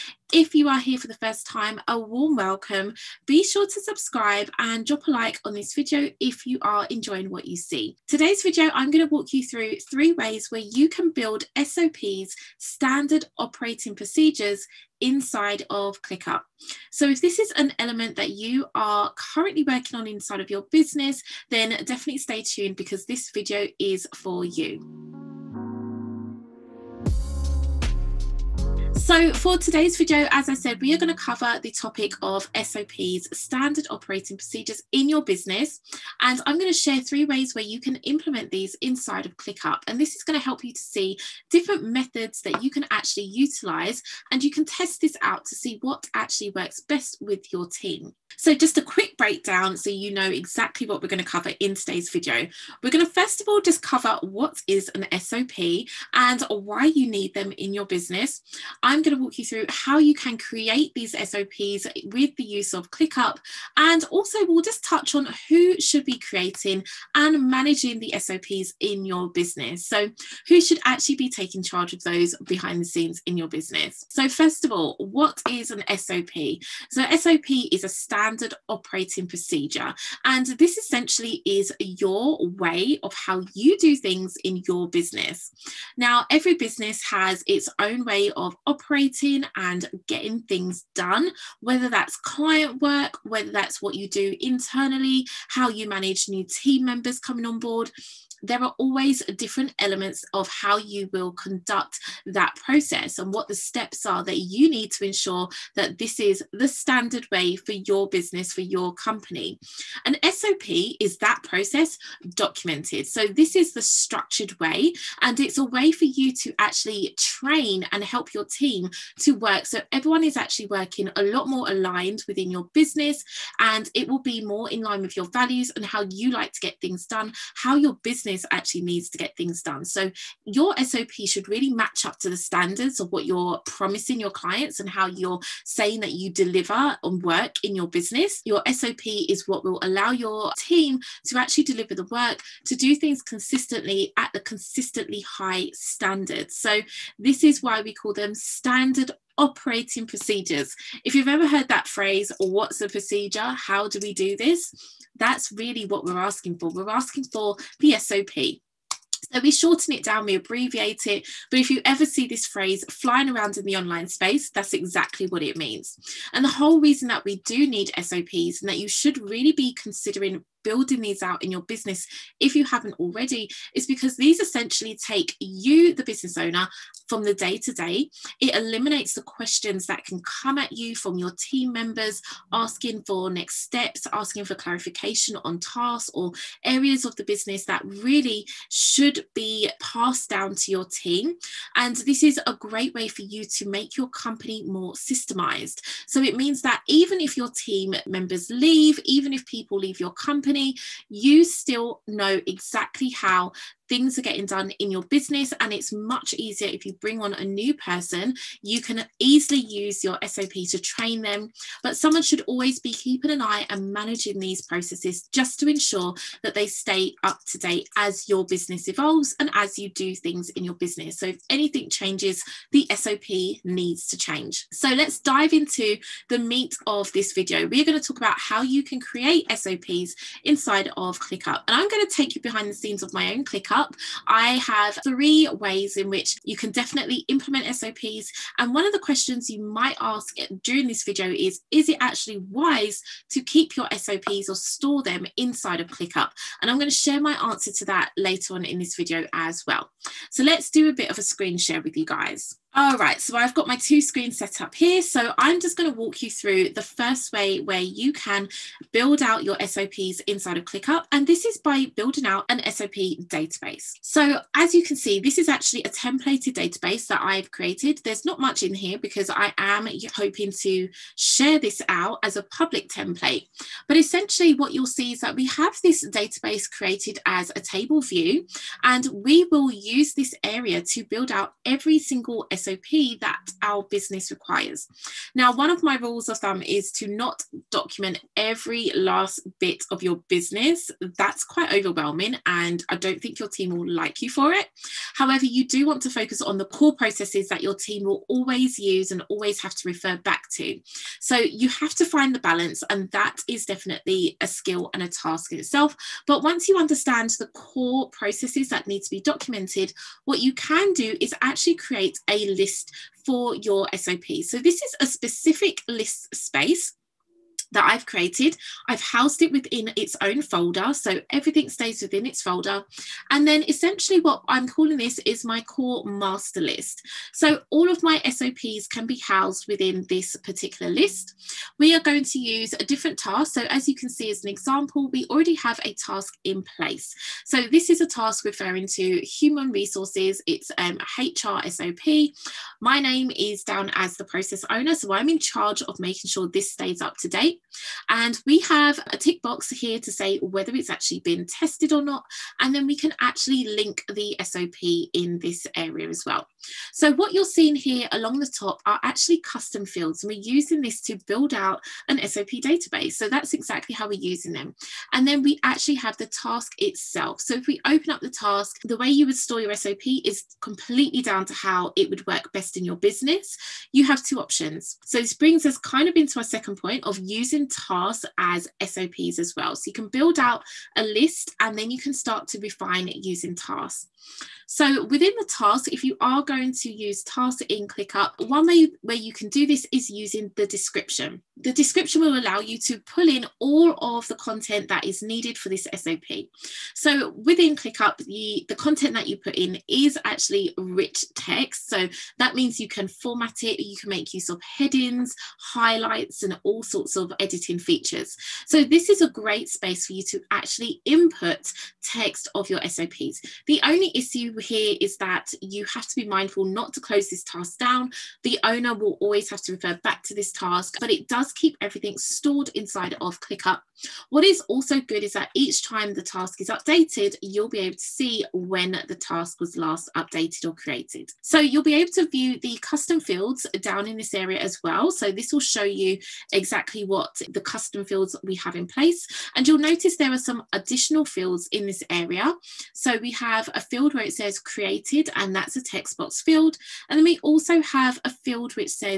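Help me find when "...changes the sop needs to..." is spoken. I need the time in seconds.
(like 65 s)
221 s.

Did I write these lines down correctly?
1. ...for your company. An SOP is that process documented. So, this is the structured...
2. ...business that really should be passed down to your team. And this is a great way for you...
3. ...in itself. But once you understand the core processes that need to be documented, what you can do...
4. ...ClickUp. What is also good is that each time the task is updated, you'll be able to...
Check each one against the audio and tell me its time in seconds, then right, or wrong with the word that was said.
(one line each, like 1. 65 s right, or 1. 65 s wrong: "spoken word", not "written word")
1. 108 s right
2. 187 s right
3. 305 s right
4. 423 s right.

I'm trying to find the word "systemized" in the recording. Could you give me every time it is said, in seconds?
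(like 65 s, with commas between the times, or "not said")
194 s.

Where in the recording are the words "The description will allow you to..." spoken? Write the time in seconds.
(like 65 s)
391 s.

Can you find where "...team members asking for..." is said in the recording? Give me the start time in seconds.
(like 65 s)
181 s.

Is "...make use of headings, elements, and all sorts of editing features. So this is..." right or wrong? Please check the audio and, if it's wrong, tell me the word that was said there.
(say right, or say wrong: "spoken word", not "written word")
wrong: "highlights", not "elements".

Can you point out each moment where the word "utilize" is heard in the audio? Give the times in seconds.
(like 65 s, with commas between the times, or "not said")
43 s.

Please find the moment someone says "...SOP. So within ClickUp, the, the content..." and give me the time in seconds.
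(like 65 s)
395 s.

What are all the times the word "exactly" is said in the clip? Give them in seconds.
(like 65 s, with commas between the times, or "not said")
50 s, 164 s, 202 s, 363 s, 436 s.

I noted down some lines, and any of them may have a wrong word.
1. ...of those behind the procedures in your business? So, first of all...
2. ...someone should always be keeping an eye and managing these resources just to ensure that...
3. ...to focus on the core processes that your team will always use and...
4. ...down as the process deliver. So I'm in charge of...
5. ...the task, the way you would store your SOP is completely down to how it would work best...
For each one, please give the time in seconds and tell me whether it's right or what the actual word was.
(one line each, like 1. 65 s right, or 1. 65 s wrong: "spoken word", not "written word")
1. 71 s wrong: "scenes", not "procedures"
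2. 211 s wrong: "processes", not "resources"
3. 296 s right
4. 343 s wrong: "owner", not "deliver"
5. 368 s right.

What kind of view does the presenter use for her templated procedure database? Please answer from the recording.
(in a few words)
table view.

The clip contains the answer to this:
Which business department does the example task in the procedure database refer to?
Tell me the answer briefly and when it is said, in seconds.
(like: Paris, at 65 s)
human resources, at 339 s.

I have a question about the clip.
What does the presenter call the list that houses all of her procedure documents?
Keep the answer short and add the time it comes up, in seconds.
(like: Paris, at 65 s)
core master list, at 325 s.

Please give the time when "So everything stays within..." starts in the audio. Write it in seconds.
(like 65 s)
320 s.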